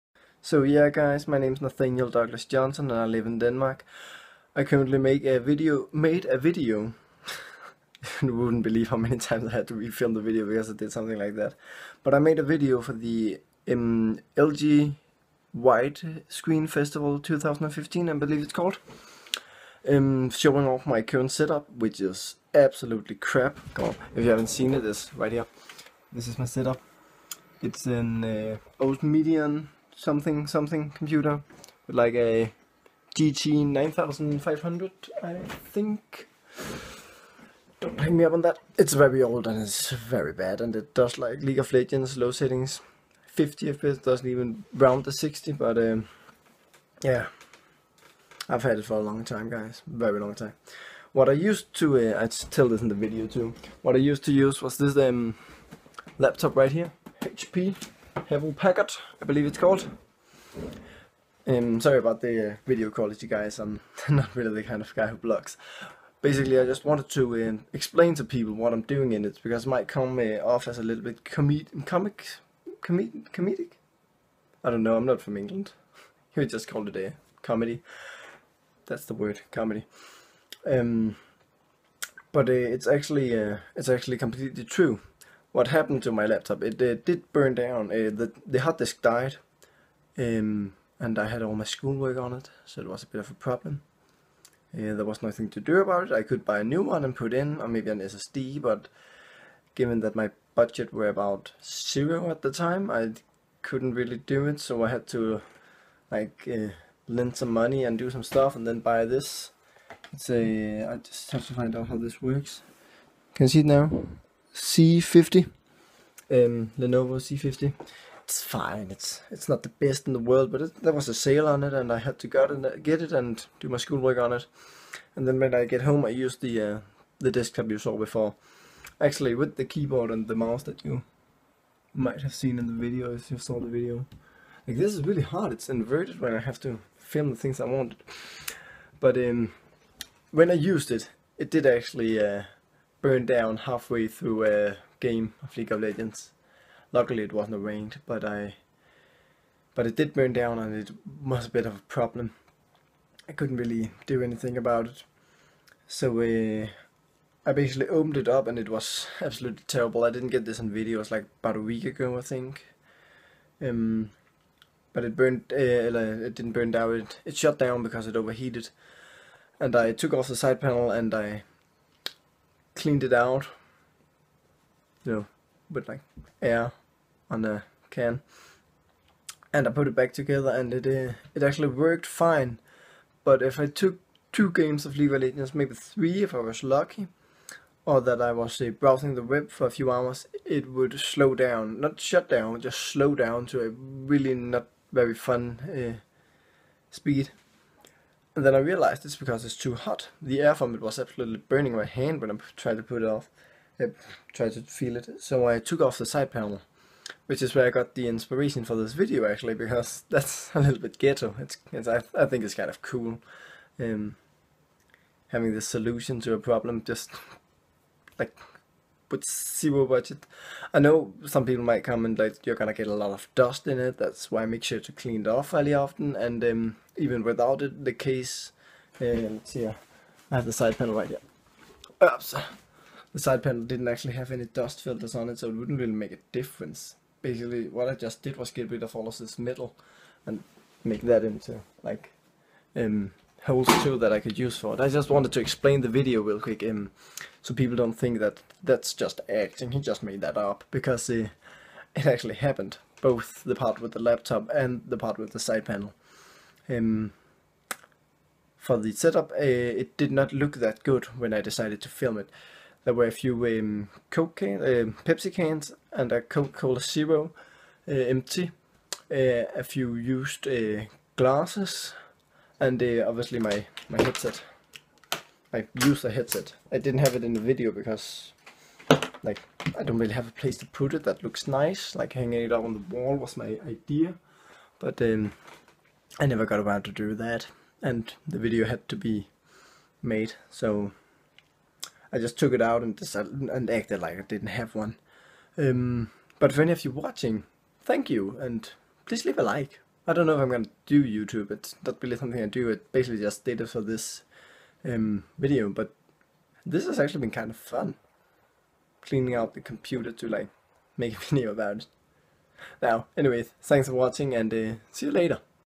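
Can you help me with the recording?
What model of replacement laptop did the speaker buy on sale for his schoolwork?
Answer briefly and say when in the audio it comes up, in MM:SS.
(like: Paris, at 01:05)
Lenovo C50, at 01:56.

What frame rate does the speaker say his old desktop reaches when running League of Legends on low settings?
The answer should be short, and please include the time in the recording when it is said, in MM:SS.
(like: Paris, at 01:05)
50 FPS, at 00:43.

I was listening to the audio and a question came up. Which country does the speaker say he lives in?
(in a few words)
Denmark.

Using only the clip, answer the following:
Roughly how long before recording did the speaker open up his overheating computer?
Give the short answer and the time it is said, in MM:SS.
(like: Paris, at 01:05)
about a week ago, at 02:41.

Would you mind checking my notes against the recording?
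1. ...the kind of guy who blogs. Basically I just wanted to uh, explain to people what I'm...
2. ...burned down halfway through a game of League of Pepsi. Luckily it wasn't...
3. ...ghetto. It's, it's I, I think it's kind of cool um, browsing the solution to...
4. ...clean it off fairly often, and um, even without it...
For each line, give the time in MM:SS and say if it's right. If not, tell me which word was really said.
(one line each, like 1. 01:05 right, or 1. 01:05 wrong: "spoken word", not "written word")
1. 01:04 right
2. 02:23 wrong: "Legends", not "Pepsi"
3. 03:30 wrong: "having", not "browsing"
4. 03:44 right.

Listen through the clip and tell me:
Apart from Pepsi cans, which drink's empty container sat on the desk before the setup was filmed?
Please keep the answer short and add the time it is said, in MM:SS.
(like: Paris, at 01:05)
Coca-Cola Zero, at 04:26.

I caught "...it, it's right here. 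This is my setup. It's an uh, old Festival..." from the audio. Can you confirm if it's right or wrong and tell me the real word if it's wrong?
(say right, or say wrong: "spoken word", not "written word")
wrong: "Medion", not "Festival".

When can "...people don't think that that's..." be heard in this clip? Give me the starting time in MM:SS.
04:07.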